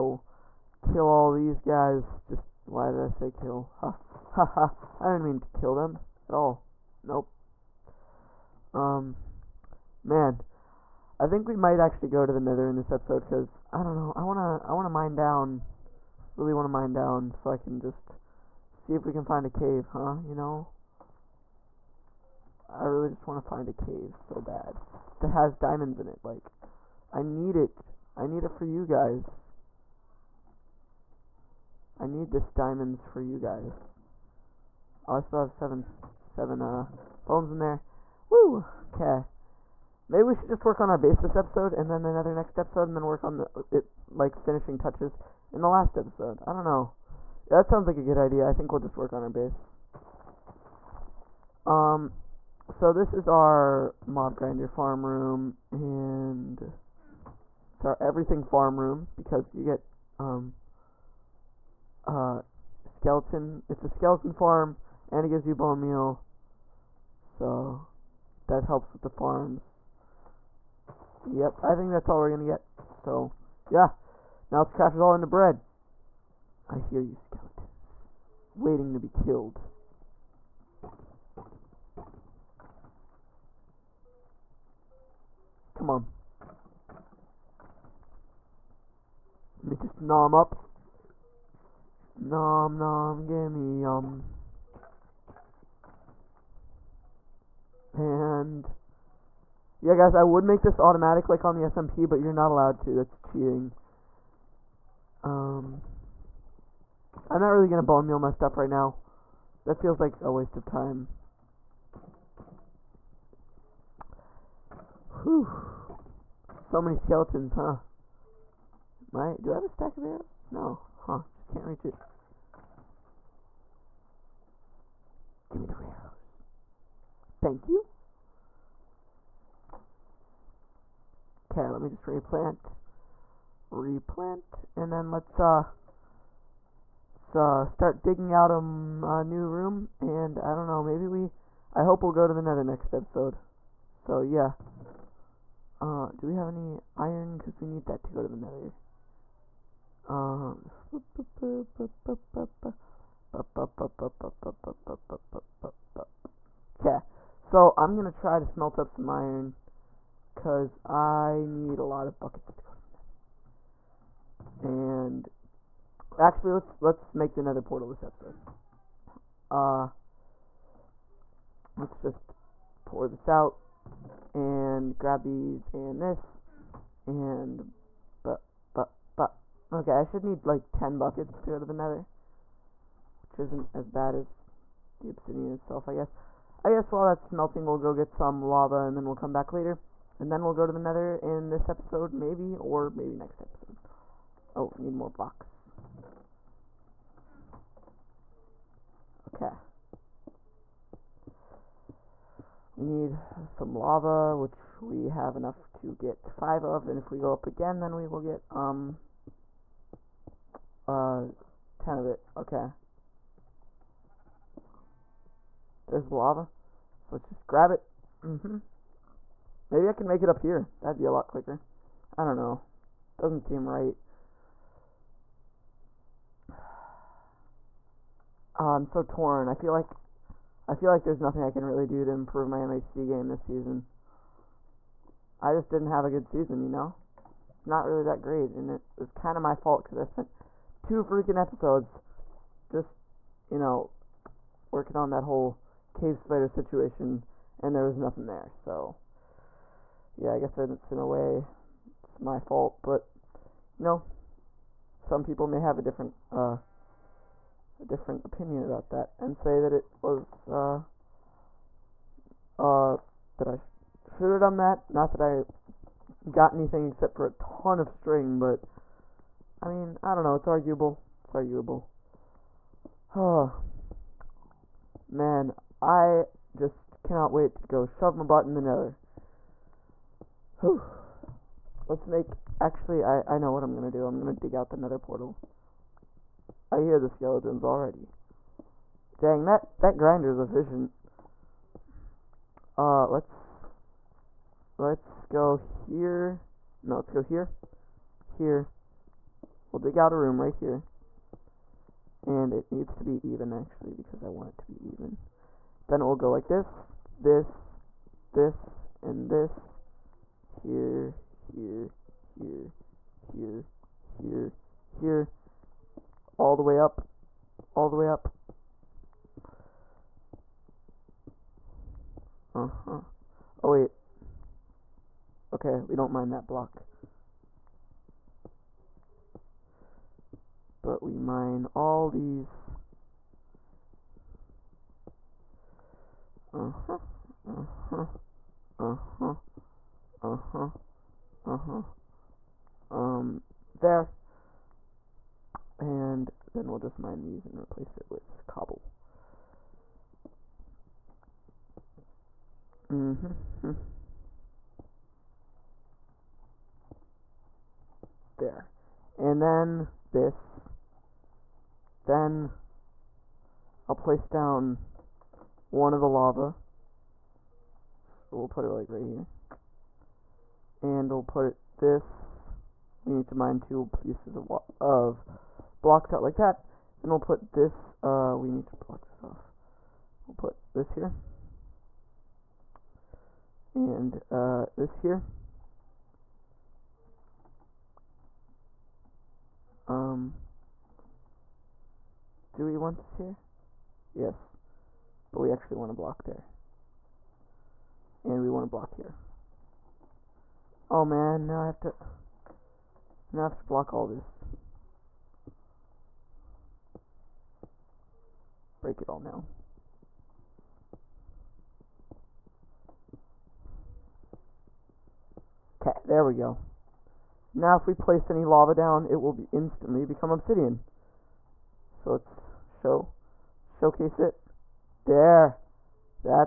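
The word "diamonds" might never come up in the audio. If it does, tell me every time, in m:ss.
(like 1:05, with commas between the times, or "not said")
0:25, 0:32.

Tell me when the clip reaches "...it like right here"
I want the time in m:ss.
6:08.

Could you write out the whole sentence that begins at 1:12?
So yeah, now let's craft it all into bread.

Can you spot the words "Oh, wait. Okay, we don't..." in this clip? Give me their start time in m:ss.
5:23.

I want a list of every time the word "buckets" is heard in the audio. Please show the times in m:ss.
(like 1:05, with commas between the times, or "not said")
2:42, 3:00.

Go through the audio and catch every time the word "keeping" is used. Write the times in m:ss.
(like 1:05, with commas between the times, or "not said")
not said.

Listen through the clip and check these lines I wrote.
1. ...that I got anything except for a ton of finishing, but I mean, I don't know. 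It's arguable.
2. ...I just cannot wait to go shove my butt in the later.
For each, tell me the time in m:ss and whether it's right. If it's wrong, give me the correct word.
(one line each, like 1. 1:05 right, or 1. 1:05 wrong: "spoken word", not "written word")
1. 4:25 wrong: "string", not "finishing"
2. 4:35 wrong: "nether", not "later".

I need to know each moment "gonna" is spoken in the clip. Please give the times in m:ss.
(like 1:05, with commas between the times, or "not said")
1:12, 1:47.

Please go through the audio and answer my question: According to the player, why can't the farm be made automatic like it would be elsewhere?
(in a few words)
That's cheating.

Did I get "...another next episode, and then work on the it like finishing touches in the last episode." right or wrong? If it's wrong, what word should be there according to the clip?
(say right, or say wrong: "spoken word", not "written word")
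right.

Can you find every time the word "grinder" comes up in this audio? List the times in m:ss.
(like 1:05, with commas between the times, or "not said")
0:54, 4:49.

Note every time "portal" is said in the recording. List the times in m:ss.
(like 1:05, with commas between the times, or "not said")
2:47, 4:44.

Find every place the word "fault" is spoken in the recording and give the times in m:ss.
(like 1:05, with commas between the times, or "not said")
3:59, 4:12.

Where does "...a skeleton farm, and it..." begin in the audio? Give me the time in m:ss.
1:03.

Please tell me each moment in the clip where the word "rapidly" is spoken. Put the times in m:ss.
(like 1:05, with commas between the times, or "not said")
not said.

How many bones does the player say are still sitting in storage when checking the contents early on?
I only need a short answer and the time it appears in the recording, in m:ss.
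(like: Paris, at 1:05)
7, at 0:35.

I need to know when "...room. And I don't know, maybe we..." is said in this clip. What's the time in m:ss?
2:19.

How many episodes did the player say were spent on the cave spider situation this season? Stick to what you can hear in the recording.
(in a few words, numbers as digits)
2.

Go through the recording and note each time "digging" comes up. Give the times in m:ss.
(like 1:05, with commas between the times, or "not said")
2:18.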